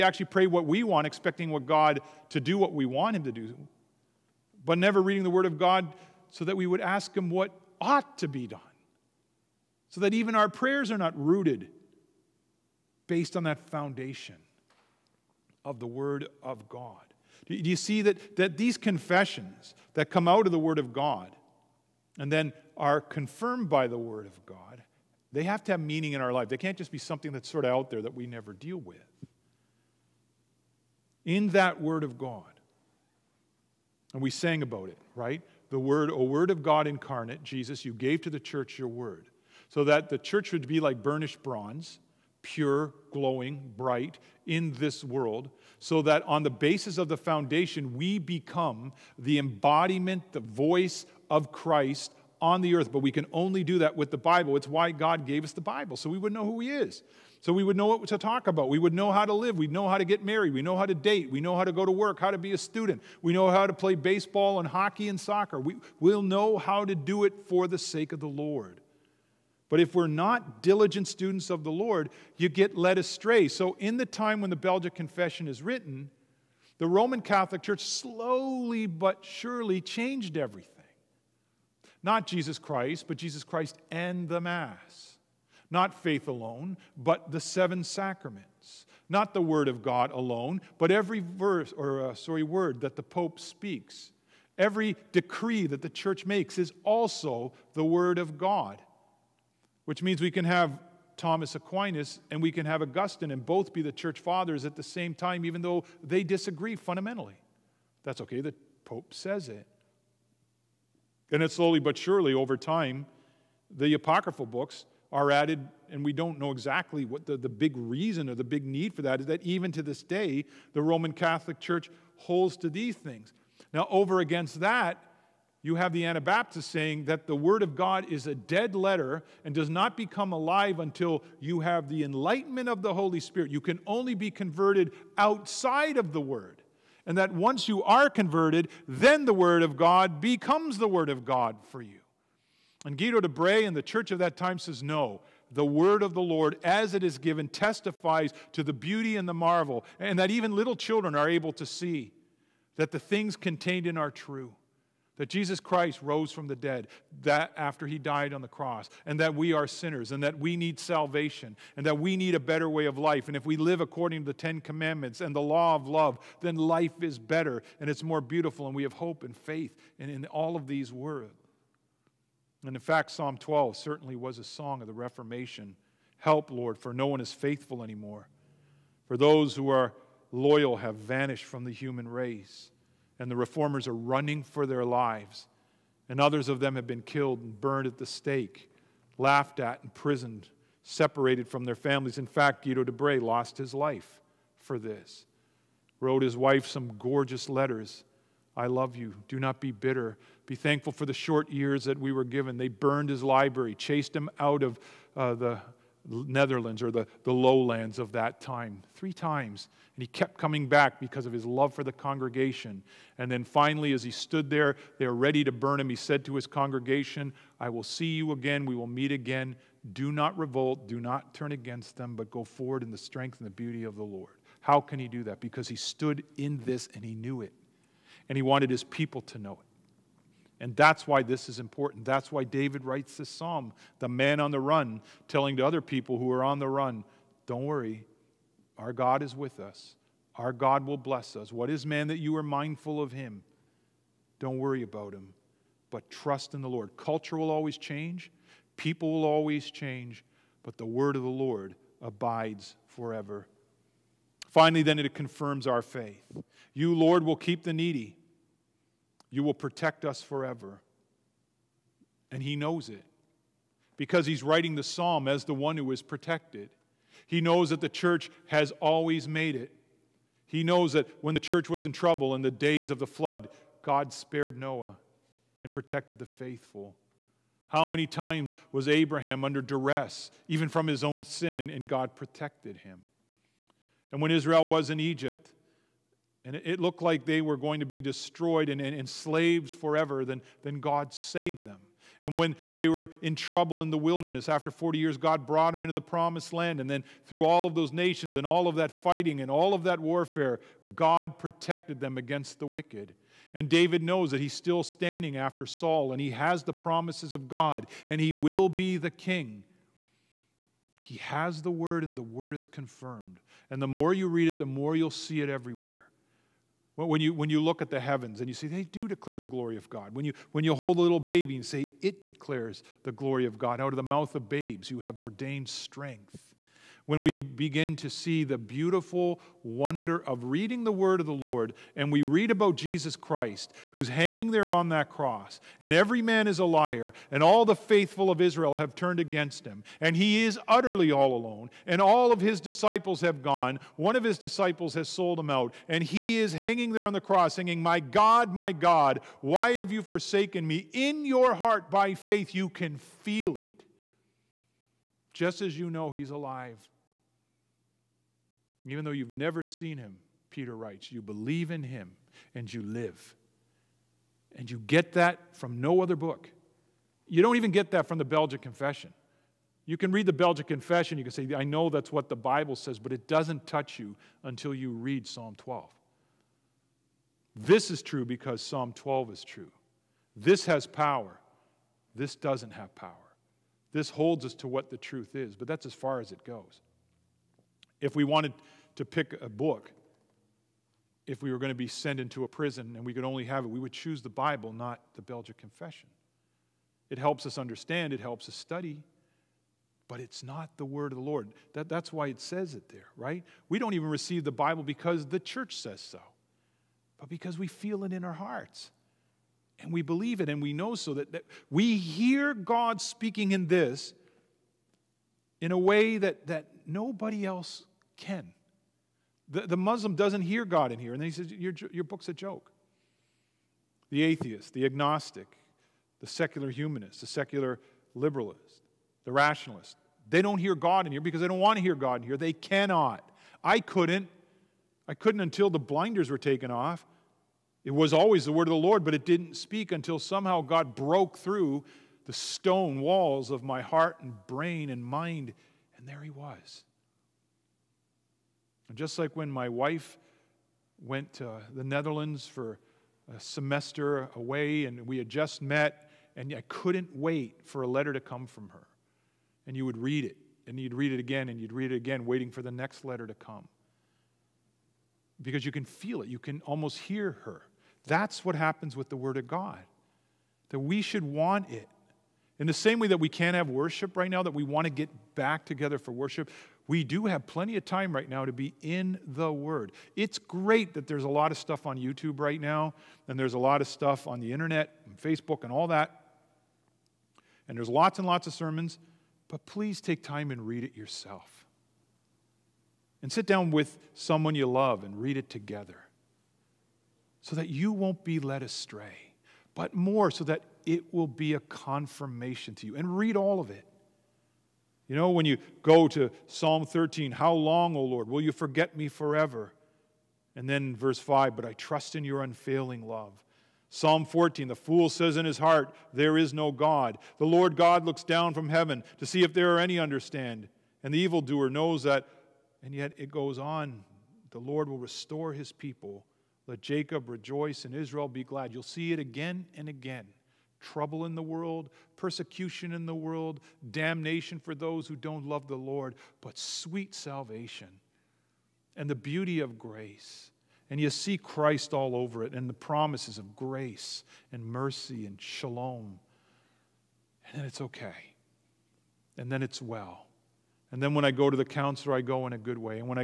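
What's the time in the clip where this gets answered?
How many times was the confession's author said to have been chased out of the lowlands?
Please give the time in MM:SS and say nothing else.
03:28.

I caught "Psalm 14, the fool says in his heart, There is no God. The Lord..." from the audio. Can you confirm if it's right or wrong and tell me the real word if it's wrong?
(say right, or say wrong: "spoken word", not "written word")
right.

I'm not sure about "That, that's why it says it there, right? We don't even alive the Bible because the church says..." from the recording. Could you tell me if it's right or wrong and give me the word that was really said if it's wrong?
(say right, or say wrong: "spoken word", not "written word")
wrong: "receive", not "alive".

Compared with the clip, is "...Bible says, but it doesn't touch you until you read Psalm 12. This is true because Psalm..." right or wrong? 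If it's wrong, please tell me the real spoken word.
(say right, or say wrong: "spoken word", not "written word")
right.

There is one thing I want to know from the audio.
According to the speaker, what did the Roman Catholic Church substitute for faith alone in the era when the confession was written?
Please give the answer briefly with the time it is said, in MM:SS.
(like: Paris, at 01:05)
the seven sacraments, at 01:27.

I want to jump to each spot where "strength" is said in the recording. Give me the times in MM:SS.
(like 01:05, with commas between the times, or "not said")
03:42, 05:25.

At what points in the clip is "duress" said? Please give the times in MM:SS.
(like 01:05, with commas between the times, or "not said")
04:39.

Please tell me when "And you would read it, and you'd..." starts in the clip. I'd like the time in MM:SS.
07:39.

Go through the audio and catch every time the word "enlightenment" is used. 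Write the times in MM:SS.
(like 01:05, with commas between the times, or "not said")
02:12.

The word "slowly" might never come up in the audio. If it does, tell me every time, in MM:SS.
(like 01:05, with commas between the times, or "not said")
01:17, 01:51.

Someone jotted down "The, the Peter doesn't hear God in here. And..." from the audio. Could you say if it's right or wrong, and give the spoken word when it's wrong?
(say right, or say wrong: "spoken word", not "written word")
wrong: "Muslim", not "Peter".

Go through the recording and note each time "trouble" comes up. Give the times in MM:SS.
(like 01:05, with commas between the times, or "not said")
04:31, 04:53, 08:50.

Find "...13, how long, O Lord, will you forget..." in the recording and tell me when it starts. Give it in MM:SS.
08:26.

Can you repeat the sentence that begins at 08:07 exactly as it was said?
And there's lots and lots of sermons, but please take time and read it yourself.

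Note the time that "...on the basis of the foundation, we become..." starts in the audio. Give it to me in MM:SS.
00:46.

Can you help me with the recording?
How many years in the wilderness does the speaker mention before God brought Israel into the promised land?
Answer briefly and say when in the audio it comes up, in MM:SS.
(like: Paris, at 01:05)
40, at 04:54.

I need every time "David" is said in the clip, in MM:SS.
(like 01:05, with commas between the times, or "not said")
03:52, 05:03.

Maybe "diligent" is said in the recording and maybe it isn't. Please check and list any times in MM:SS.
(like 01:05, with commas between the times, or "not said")
01:10.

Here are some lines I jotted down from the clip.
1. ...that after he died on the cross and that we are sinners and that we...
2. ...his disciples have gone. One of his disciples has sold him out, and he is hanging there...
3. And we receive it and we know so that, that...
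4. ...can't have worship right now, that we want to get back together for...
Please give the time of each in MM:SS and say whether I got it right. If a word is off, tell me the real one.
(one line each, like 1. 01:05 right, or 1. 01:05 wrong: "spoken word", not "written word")
1. 02:37 right
2. 05:42 right
3. 06:49 wrong: "believe", not "receive"
4. 07:53 right.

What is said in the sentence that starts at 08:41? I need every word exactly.
And the evildoer knows that, and yet it goes on.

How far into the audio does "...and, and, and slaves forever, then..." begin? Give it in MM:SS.
04:48.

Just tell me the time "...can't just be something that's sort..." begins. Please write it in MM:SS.
00:26.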